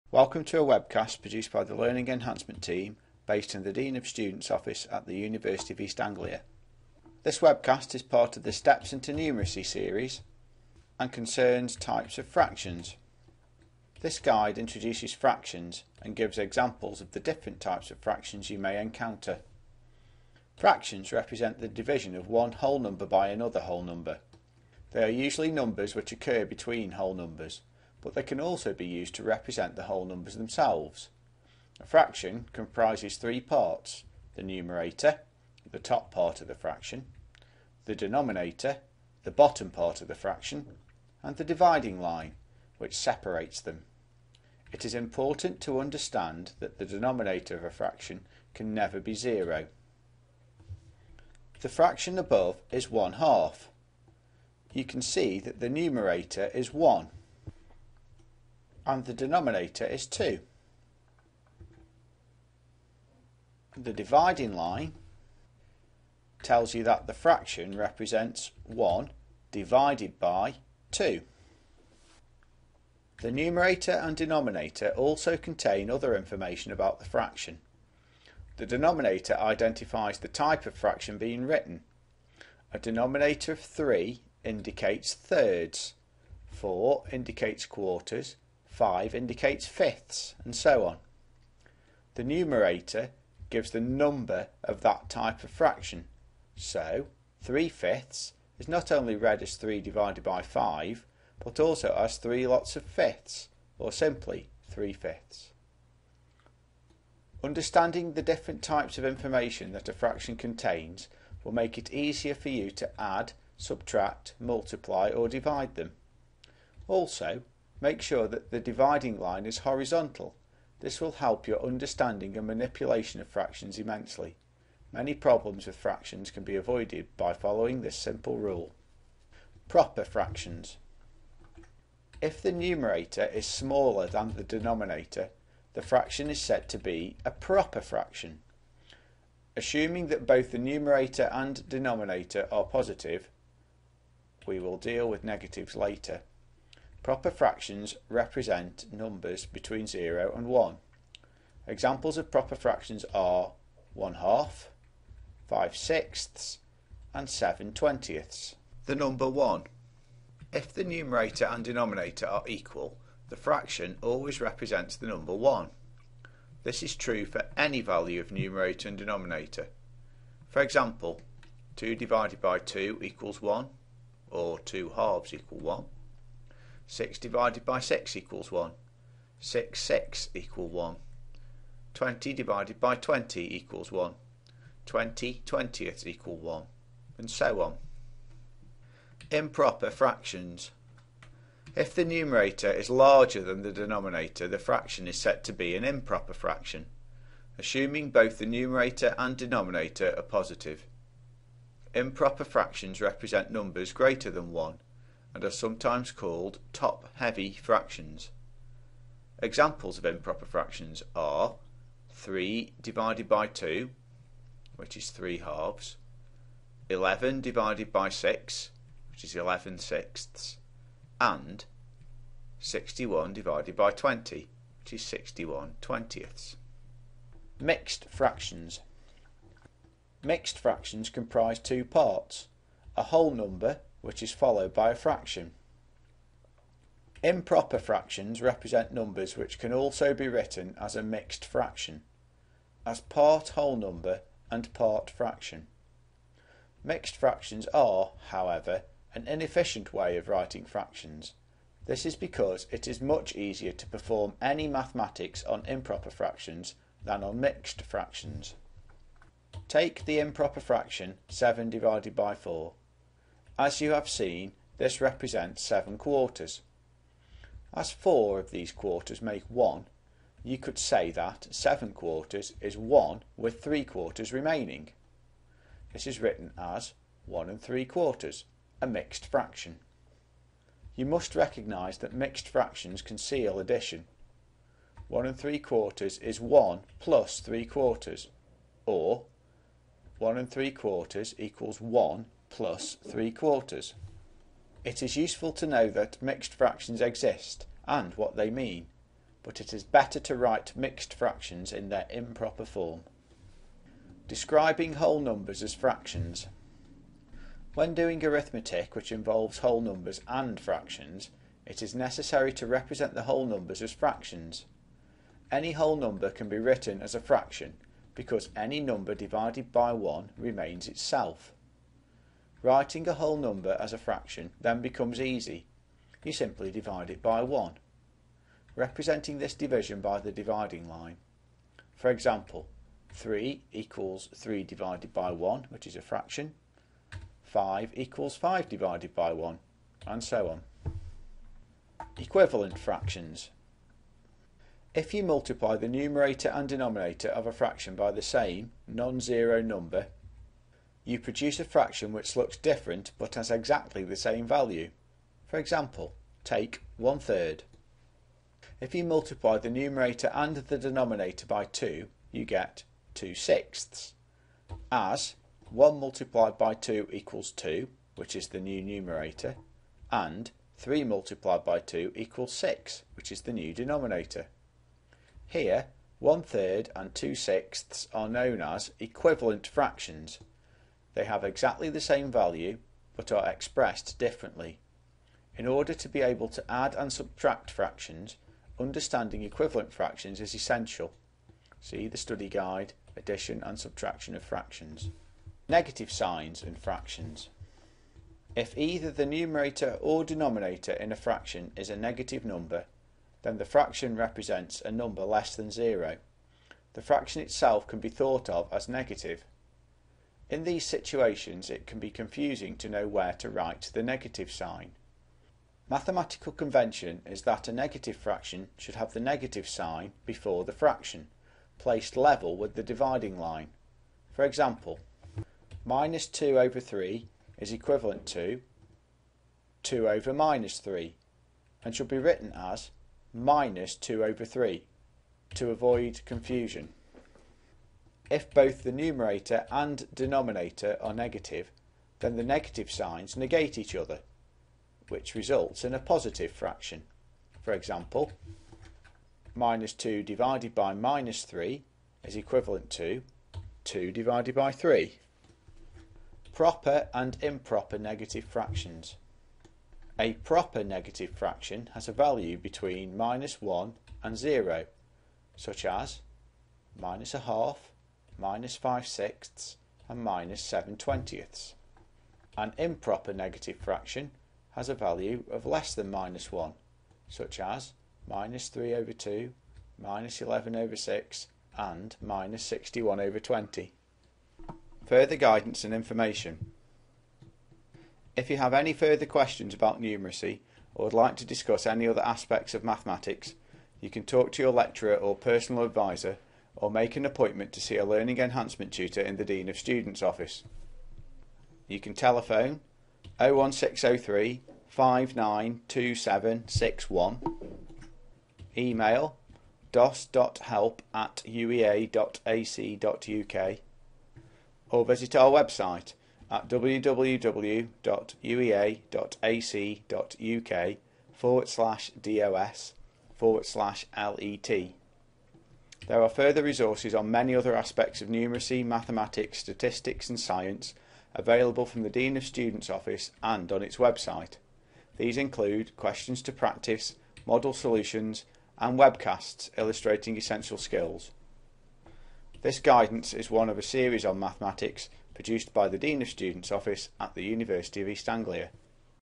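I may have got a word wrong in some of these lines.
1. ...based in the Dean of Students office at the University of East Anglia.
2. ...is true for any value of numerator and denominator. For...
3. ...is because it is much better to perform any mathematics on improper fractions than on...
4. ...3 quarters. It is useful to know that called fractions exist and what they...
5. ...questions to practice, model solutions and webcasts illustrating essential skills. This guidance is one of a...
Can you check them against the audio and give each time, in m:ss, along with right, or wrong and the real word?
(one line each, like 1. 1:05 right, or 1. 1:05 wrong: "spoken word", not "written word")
1. 0:03 right
2. 2:46 right
3. 4:12 wrong: "easier", not "better"
4. 4:53 wrong: "mixed", not "called"
5. 8:55 right.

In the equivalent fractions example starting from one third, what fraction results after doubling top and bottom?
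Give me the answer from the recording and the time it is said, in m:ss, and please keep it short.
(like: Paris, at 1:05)
2 sixths, at 6:03.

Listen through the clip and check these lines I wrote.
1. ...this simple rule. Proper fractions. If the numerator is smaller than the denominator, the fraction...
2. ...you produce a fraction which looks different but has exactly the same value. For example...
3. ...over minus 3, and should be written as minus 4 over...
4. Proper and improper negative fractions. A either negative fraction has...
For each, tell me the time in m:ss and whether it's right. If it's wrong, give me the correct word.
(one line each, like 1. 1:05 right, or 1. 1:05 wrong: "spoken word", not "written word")
1. 2:07 right
2. 5:51 right
3. 7:10 wrong: "2", not "4"
4. 7:36 wrong: "proper", not "either".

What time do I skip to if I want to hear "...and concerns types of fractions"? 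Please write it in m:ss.
0:10.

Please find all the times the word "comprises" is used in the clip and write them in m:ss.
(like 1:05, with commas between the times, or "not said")
0:32, 3:51.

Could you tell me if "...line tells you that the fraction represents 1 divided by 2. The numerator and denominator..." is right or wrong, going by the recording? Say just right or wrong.
right.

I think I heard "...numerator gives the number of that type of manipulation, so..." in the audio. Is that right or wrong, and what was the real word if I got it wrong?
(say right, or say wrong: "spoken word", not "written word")
wrong: "fraction", not "manipulation".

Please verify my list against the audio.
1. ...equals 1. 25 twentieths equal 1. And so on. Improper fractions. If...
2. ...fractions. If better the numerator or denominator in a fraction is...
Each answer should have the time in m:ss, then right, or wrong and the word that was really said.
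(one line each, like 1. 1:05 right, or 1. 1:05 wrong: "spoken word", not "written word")
1. 3:03 wrong: "20", not "25"
2. 6:36 wrong: "either", not "better".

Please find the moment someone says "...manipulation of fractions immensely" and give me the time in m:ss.
2:02.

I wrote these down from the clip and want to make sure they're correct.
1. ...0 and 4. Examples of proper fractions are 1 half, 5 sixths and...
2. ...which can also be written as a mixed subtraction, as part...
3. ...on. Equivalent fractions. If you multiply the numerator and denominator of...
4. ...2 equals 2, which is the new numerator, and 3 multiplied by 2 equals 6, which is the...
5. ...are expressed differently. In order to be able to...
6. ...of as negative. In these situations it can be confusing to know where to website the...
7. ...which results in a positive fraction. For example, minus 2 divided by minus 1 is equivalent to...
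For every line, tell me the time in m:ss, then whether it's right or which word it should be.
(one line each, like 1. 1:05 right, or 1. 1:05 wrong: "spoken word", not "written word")
1. 2:29 wrong: "1", not "4"
2. 3:59 wrong: "fraction", not "subtraction"
3. 5:40 right
4. 6:06 right
5. 6:23 right
6. 6:48 wrong: "write", not "website"
7. 7:25 wrong: "3", not "1".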